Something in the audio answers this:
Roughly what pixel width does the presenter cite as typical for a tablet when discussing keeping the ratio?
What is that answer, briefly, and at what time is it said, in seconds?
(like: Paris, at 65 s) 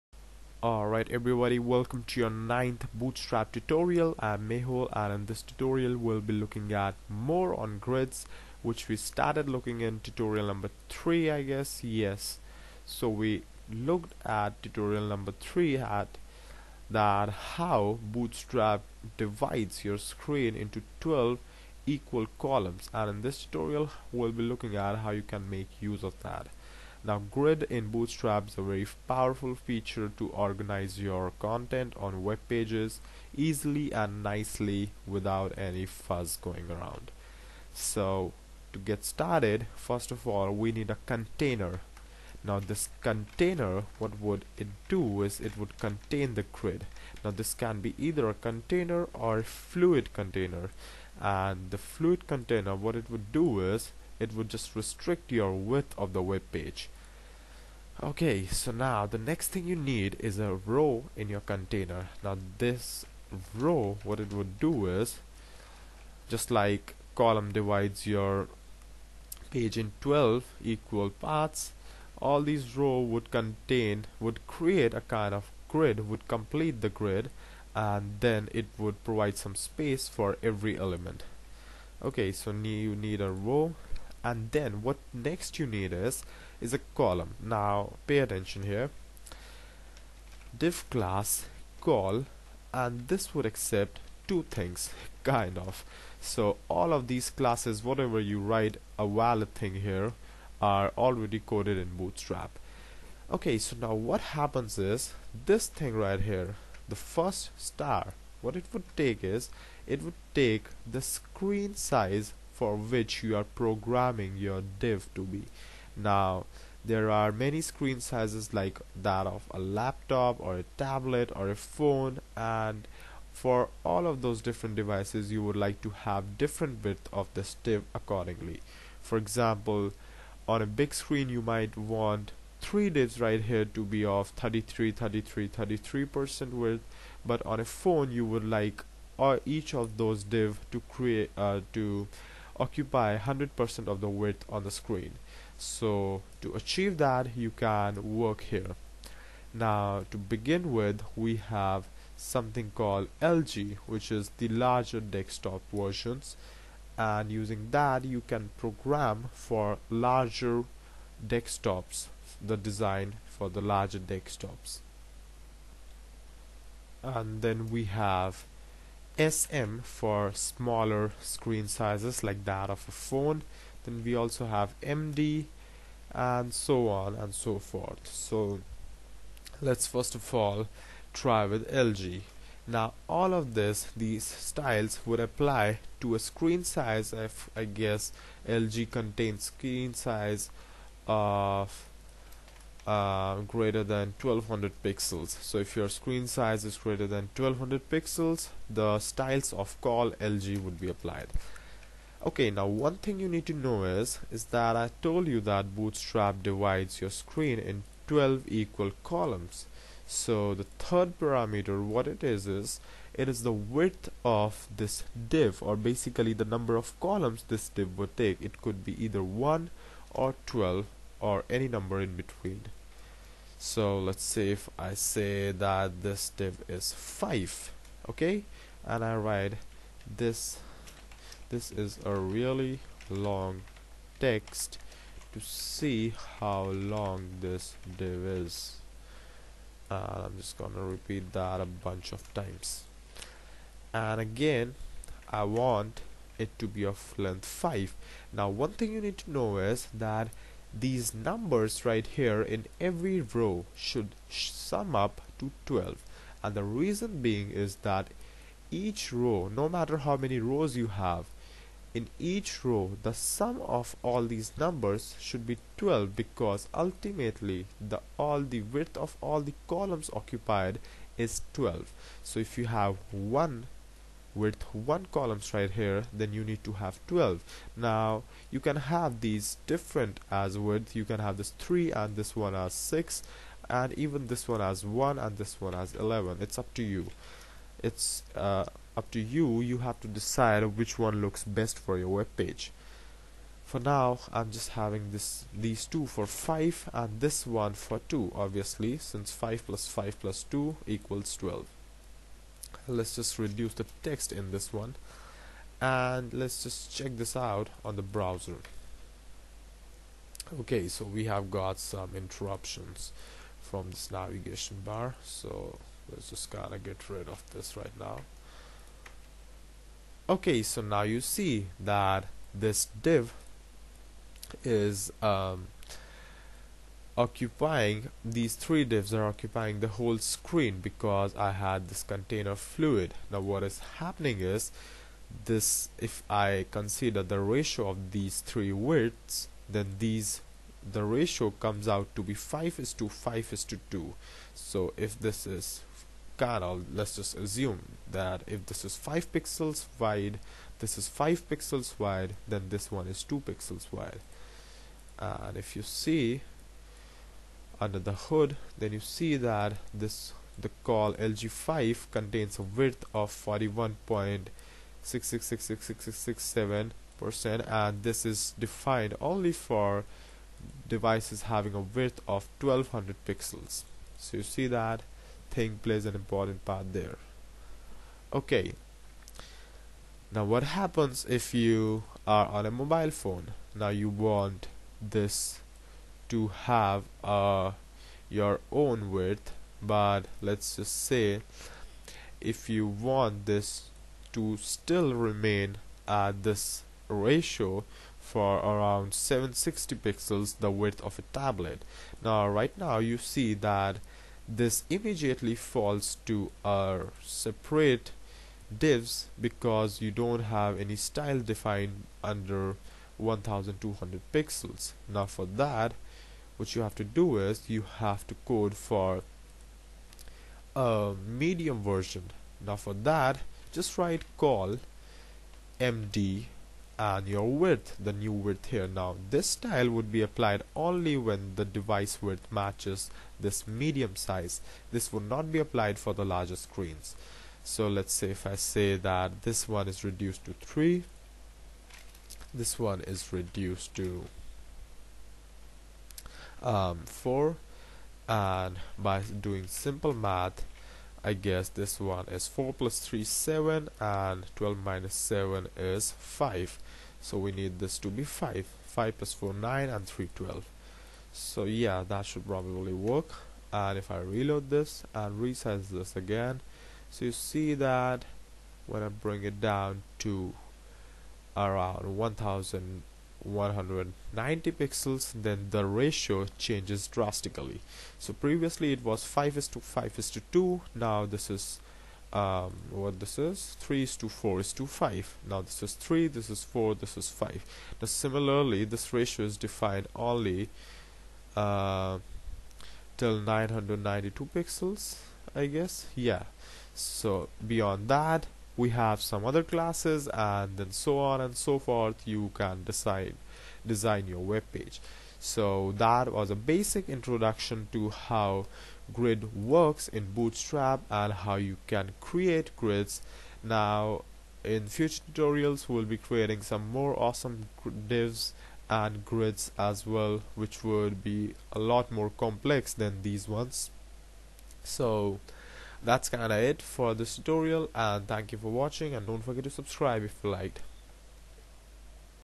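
760 pixels, at 399 s.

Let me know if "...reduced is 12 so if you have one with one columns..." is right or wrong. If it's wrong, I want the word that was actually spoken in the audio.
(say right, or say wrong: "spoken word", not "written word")
wrong: "occupied", not "reduced".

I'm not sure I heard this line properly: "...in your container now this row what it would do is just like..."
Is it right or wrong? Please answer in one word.
right.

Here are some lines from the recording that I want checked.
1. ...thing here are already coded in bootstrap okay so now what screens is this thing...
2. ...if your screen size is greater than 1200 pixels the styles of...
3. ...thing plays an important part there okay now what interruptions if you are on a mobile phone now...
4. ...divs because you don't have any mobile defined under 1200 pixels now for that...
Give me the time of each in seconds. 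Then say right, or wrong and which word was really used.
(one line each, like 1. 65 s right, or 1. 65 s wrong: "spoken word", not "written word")
1. 99 s wrong: "happens", not "screens"
2. 195 s right
3. 375 s wrong: "happens", not "interruptions"
4. 408 s wrong: "style", not "mobile".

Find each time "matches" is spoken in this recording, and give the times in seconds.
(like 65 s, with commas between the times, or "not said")
432 s.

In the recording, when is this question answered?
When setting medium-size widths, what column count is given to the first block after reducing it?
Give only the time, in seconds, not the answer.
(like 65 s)
440 s.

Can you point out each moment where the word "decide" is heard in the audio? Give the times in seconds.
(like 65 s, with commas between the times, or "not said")
290 s, 502 s.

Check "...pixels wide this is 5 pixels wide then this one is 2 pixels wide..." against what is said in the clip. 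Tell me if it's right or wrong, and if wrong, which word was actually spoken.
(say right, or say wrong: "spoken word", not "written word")
right.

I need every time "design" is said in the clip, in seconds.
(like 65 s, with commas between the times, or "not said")
162 s, 503 s.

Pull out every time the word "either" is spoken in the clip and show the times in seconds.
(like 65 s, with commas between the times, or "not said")
47 s, 219 s.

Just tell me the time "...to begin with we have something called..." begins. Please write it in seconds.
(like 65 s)
150 s.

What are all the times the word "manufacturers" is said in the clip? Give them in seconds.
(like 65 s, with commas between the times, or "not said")
not said.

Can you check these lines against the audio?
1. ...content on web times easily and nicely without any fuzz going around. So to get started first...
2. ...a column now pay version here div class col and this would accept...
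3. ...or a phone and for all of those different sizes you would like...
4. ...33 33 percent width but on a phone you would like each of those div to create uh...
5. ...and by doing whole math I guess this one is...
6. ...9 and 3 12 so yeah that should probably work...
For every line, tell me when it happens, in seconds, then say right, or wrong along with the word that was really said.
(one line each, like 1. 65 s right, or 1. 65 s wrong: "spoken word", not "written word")
1. 31 s wrong: "pages", not "times"
2. 86 s wrong: "attention", not "version"
3. 121 s wrong: "devices", not "sizes"
4. 134 s right
5. 448 s wrong: "simple", not "whole"
6. 459 s right.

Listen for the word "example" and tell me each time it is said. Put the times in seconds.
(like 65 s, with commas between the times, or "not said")
129 s.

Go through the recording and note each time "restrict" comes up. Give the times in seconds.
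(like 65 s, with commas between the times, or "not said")
54 s.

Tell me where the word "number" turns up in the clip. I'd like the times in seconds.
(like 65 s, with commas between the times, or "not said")
10 s, 15 s, 216 s, 221 s, 251 s, 264 s.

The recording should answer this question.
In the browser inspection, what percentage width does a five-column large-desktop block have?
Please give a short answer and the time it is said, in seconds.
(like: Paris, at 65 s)
41.6666667 percent, at 363 s.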